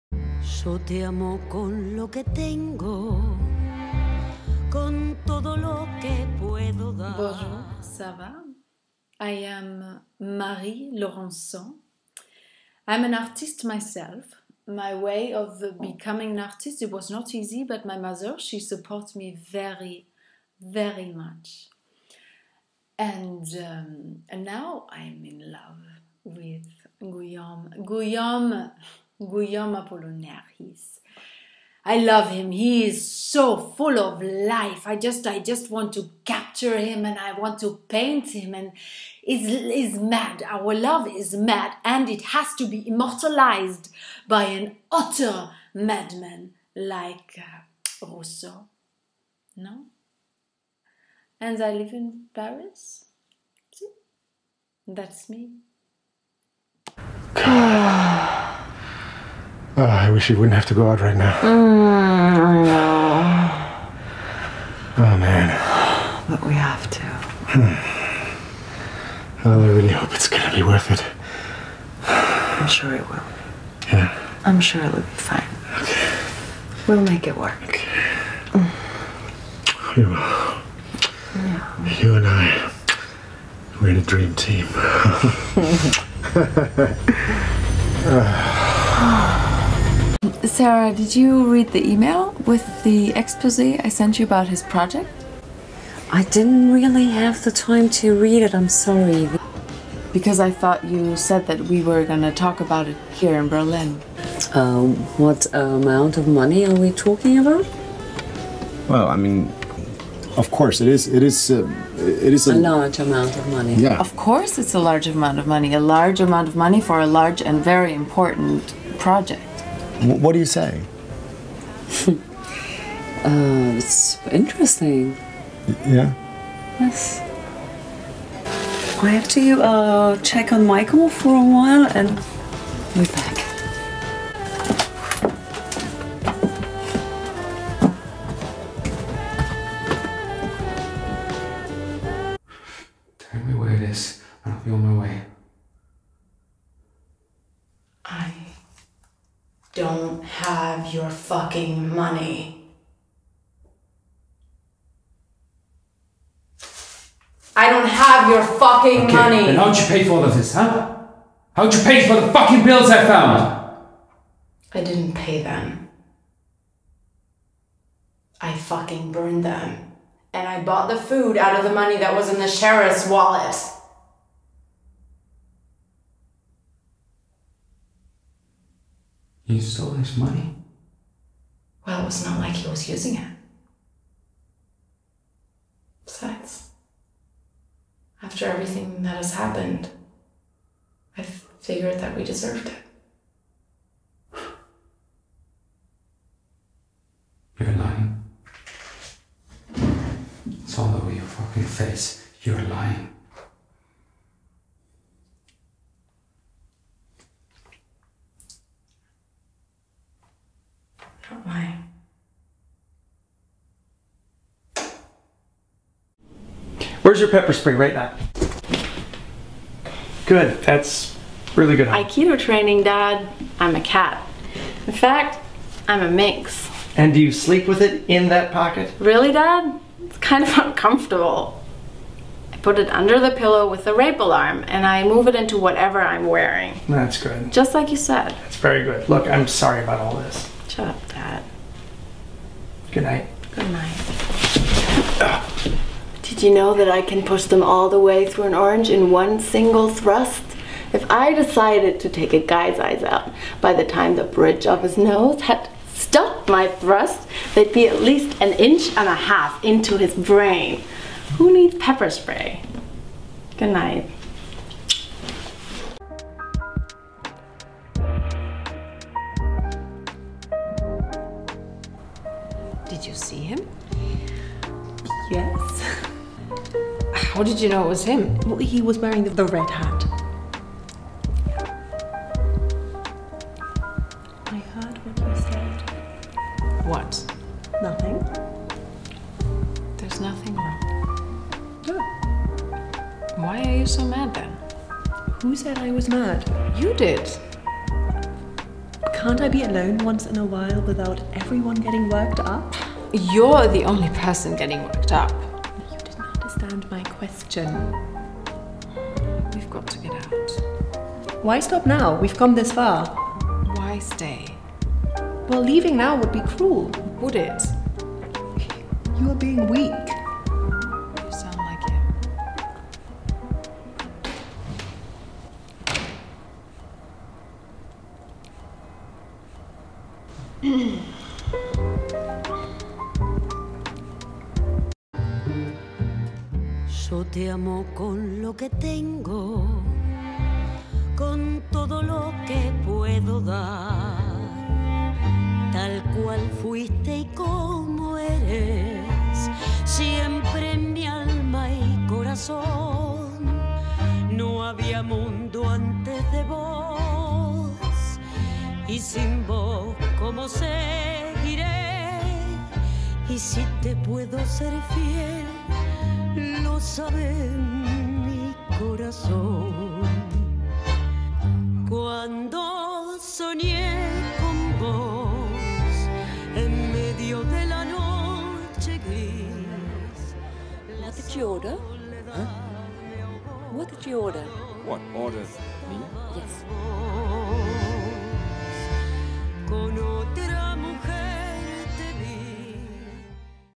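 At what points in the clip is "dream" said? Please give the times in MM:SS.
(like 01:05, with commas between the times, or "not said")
01:24.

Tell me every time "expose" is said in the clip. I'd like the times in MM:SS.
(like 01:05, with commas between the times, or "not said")
01:33.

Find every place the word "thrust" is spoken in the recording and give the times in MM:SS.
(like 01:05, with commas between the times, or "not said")
04:09, 04:16.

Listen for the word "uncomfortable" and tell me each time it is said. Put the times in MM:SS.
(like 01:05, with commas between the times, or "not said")
03:50.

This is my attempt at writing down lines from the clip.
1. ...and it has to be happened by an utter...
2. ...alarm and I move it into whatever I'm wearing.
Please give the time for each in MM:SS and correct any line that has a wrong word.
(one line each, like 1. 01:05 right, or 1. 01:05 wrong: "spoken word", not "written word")
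1. 00:41 wrong: "immortalized", not "happened"
2. 03:54 right.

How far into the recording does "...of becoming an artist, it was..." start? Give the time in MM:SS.
00:15.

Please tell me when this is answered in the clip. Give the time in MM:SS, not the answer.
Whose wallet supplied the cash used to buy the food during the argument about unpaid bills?
02:52.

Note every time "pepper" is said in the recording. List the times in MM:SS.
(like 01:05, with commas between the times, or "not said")
03:37, 04:21.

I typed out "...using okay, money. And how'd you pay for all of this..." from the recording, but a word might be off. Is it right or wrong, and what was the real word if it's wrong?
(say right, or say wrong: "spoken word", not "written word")
wrong: "fucking", not "using".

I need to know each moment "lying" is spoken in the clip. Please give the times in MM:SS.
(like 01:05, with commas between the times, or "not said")
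03:17, 03:22.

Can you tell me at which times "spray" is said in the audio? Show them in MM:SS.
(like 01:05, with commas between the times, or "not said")
03:37, 04:22.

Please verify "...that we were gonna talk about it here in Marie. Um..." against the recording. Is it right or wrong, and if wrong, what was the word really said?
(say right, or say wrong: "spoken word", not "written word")
wrong: "Berlin", not "Marie".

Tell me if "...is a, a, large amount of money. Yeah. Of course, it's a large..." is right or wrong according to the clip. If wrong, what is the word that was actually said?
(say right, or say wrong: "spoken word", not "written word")
right.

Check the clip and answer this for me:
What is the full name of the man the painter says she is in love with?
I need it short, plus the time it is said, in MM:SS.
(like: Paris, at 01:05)
Guillaume Apollinaire, at 00:29.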